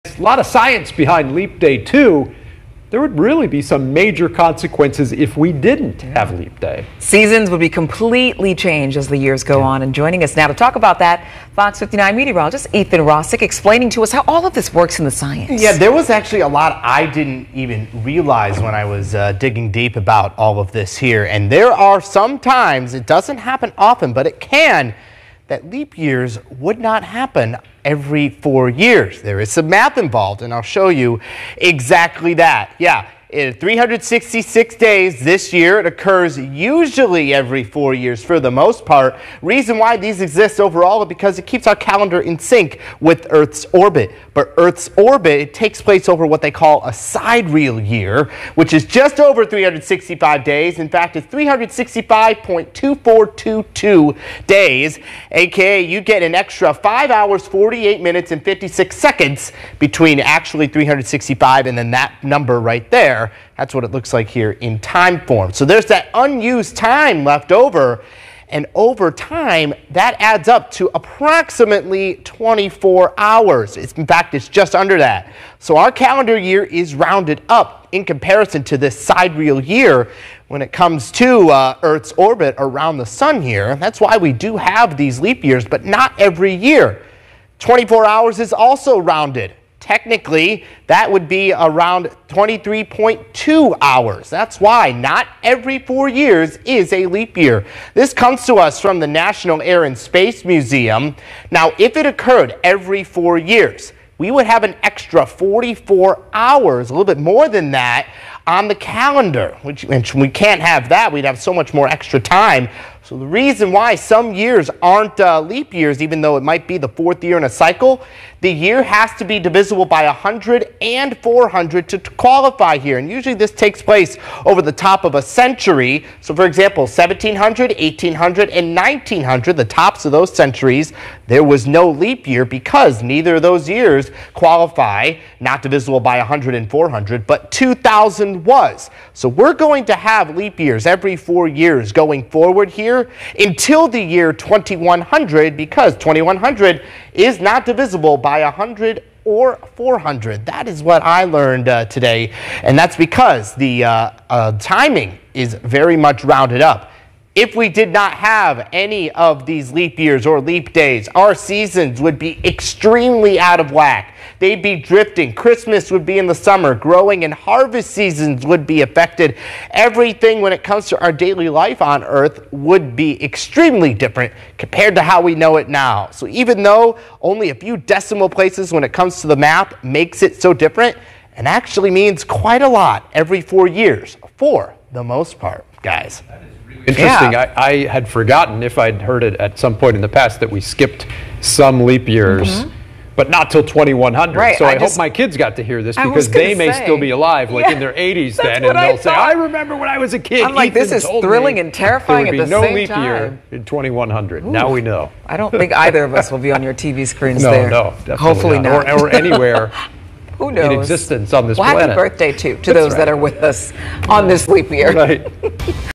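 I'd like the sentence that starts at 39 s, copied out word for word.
Reason why these exist overall is because it keeps our calendar in sync with Earth's orbit.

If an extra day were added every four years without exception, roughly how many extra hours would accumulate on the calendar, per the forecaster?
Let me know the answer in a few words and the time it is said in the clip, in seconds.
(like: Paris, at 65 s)
44 hours, at 105 s.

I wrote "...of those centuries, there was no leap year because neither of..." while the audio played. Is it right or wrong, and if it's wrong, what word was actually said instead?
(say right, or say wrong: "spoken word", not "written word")
right.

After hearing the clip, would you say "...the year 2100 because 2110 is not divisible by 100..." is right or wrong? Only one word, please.
wrong.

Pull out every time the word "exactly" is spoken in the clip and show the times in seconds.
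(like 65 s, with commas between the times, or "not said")
31 s.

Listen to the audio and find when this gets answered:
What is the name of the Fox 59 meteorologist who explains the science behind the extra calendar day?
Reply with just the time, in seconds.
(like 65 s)
12 s.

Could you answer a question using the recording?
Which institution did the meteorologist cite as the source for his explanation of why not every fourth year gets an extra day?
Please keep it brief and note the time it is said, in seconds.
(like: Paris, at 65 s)
National Air and Space Museum, at 99 s.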